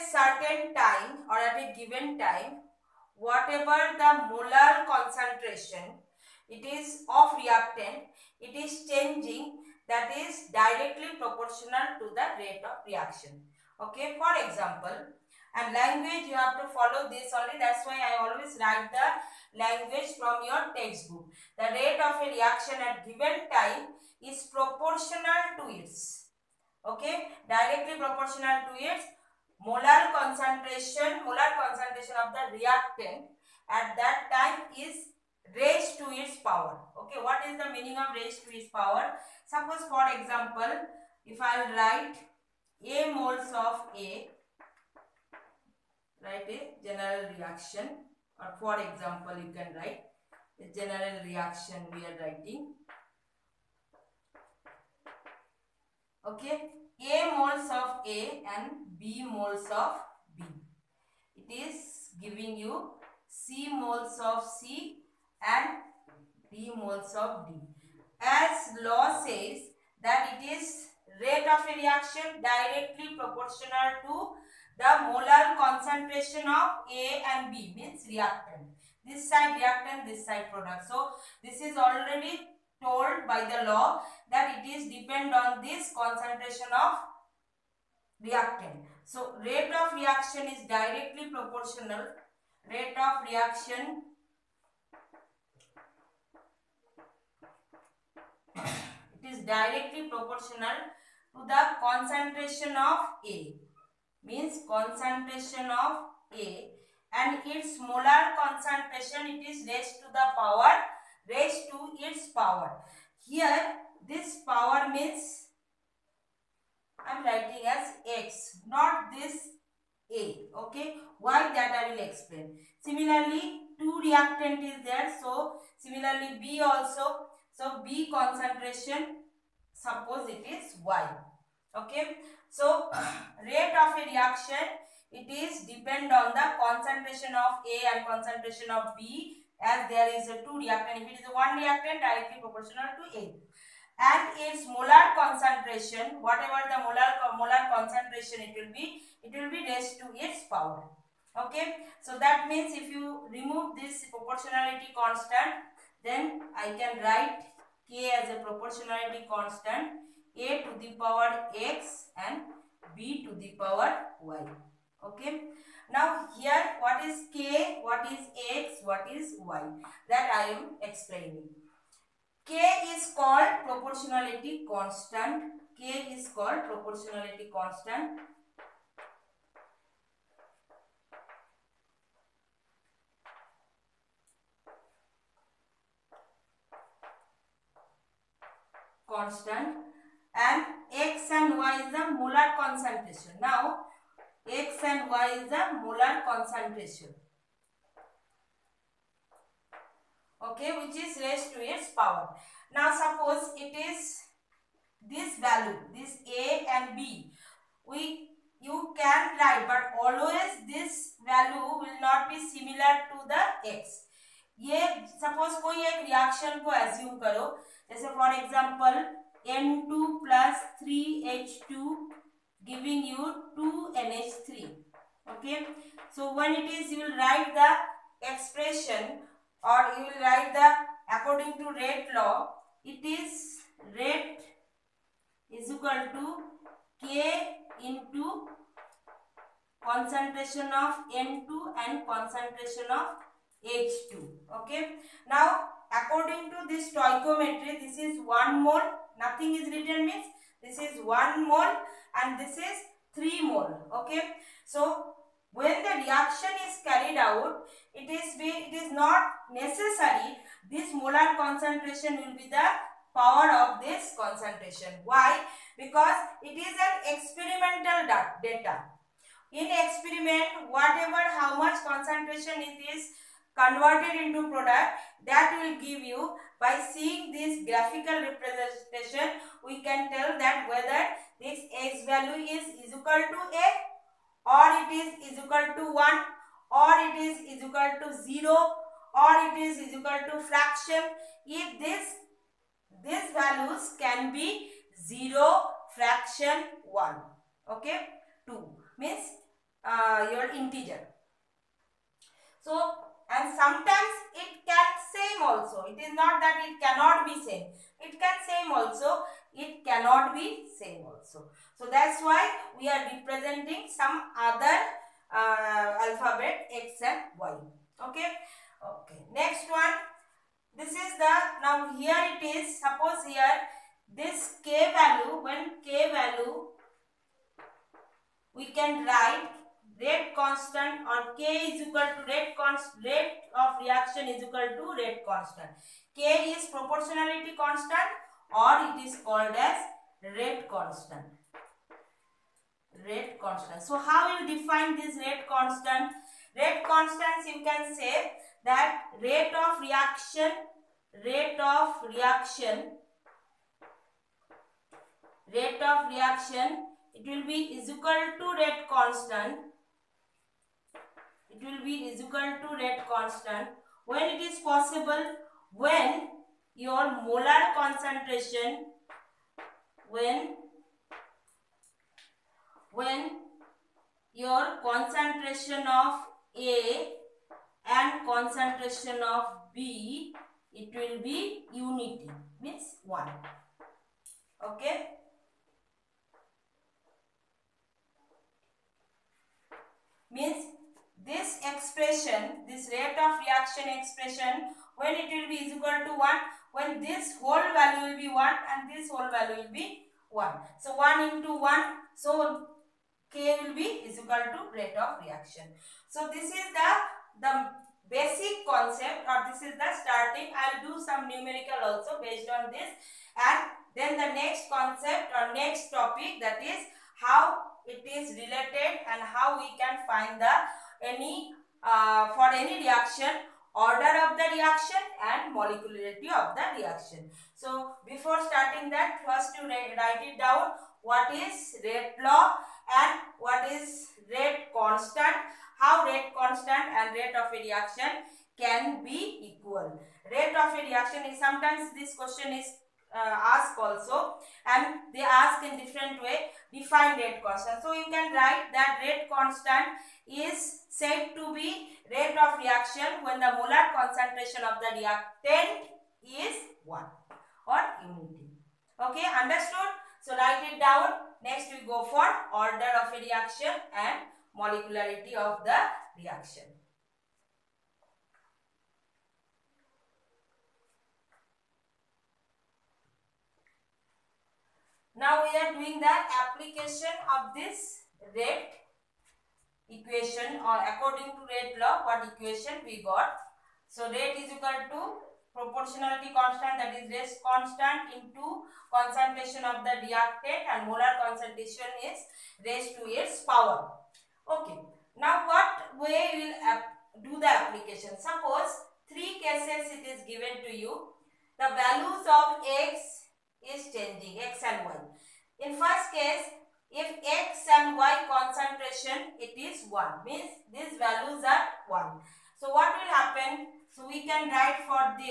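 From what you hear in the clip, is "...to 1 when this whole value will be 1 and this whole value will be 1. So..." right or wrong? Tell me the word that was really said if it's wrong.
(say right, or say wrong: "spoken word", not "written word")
right.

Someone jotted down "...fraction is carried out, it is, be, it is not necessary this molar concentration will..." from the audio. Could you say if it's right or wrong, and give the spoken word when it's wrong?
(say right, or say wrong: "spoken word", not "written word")
wrong: "reaction", not "fraction".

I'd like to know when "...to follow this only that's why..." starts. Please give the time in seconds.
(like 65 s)
16 s.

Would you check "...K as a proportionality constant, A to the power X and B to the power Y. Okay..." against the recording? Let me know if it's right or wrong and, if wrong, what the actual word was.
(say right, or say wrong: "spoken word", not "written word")
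right.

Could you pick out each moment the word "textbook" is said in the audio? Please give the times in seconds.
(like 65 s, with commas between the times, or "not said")
20 s.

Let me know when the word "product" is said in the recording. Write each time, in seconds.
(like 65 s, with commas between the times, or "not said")
80 s, 274 s.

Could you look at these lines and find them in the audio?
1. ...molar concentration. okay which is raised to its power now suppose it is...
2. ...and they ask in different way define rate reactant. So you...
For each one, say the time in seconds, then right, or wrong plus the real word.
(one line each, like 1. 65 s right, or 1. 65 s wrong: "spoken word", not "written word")
1. 195 s right
2. 444 s wrong: "constant", not "reactant".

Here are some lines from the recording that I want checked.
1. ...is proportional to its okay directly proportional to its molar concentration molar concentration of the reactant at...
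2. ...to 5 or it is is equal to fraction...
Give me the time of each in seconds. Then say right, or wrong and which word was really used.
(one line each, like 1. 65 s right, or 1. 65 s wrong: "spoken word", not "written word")
1. 24 s right
2. 288 s wrong: "0", not "5".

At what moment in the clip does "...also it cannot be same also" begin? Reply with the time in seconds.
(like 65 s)
308 s.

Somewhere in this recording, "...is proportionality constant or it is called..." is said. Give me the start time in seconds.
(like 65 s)
336 s.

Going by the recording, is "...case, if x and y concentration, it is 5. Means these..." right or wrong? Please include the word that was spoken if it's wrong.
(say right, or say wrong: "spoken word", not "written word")
wrong: "1", not "5".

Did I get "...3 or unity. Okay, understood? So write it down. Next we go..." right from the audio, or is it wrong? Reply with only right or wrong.
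wrong.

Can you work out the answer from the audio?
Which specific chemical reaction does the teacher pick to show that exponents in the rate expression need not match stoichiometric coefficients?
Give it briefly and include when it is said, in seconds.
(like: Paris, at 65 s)
N2 plus 3H2 giving 2NH3, at 219 s.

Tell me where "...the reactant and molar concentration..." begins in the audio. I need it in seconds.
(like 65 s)
489 s.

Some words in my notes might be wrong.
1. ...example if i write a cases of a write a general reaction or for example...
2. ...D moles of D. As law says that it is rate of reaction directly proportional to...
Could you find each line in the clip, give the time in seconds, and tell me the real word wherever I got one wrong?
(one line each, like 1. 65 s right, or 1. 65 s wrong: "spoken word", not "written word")
1. 40 s wrong: "moles", not "cases"
2. 66 s right.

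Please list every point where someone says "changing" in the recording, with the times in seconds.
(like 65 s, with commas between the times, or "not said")
8 s, 503 s.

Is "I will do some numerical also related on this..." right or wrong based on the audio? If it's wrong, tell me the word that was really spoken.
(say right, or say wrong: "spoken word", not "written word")
wrong: "based", not "related".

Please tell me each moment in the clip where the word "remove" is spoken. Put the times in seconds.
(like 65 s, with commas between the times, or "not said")
153 s.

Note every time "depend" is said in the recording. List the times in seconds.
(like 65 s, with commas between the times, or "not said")
84 s, 135 s.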